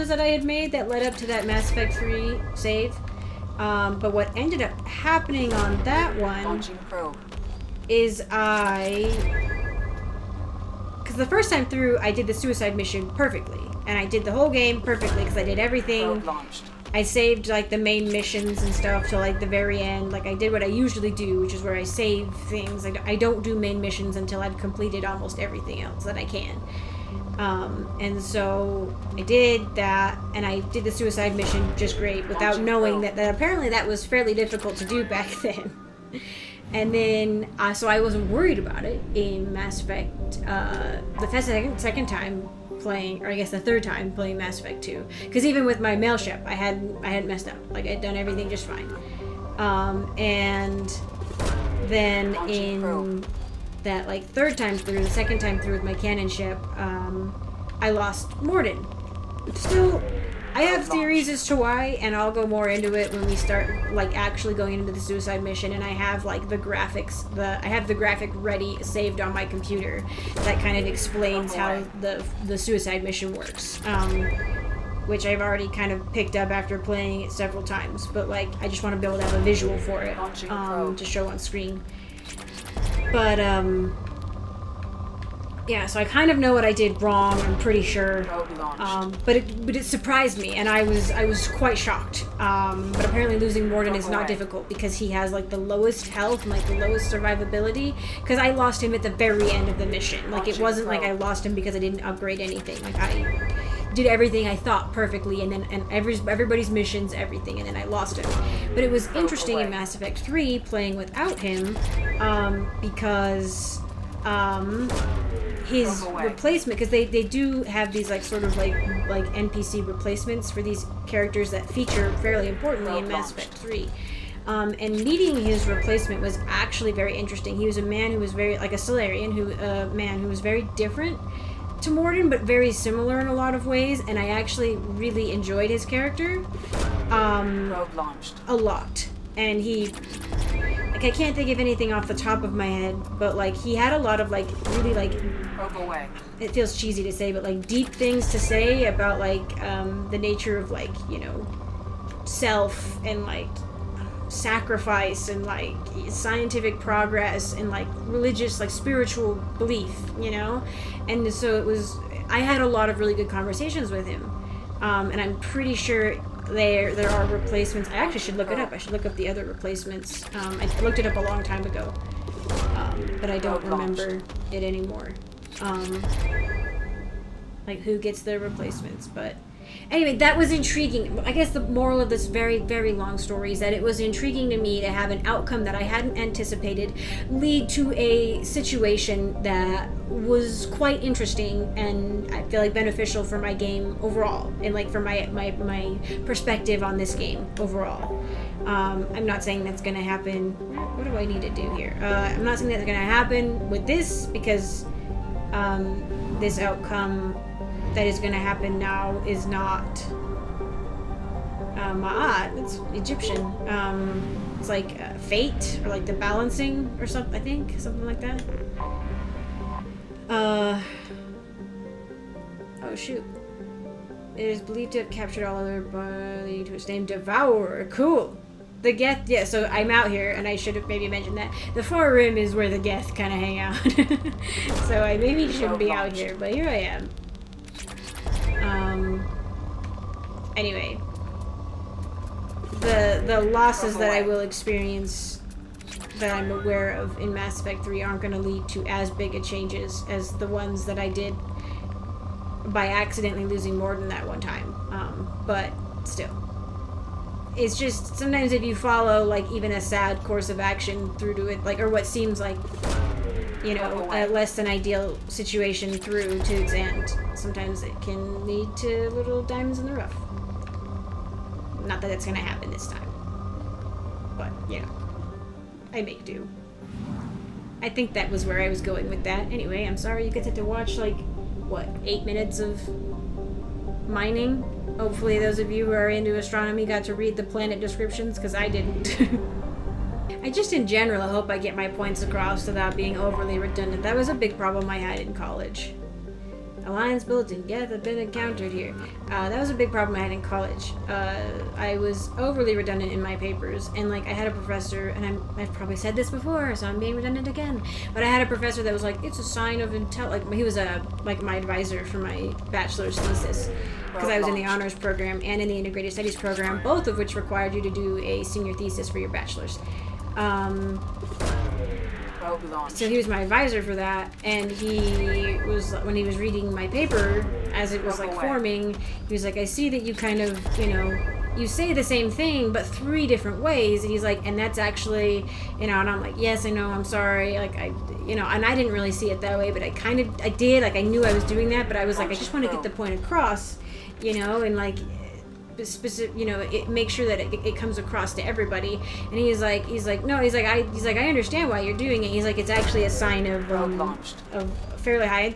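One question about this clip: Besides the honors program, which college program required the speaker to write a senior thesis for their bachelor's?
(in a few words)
Integrated studies program.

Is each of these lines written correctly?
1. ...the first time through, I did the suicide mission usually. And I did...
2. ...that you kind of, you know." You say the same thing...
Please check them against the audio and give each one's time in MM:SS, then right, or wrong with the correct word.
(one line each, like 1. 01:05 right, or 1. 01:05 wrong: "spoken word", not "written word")
1. 00:11 wrong: "perfectly", not "usually"
2. 05:29 right.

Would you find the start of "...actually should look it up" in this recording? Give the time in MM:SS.
02:47.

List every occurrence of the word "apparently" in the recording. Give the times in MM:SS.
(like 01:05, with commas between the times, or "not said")
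00:33, 01:33.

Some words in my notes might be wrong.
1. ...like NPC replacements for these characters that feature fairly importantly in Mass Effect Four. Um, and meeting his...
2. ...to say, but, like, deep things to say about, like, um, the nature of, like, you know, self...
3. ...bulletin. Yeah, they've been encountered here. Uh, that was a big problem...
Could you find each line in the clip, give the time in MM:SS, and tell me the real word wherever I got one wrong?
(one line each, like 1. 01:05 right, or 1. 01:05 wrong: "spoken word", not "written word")
1. 01:59 wrong: "Three", not "Four"
2. 02:27 right
3. 04:57 right.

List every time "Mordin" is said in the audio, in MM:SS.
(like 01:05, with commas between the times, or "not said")
00:58, 01:33, 02:11, 04:13.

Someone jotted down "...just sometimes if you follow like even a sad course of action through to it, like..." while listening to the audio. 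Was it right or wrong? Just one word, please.
right.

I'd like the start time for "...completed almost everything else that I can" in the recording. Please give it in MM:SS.
00:24.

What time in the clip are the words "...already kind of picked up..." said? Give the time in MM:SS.
01:15.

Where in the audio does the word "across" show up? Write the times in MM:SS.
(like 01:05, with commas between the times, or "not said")
04:52, 05:43, 05:47.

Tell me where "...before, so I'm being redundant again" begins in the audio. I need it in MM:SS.
05:06.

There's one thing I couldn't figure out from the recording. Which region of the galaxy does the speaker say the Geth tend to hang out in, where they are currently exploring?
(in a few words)
The Far Rim.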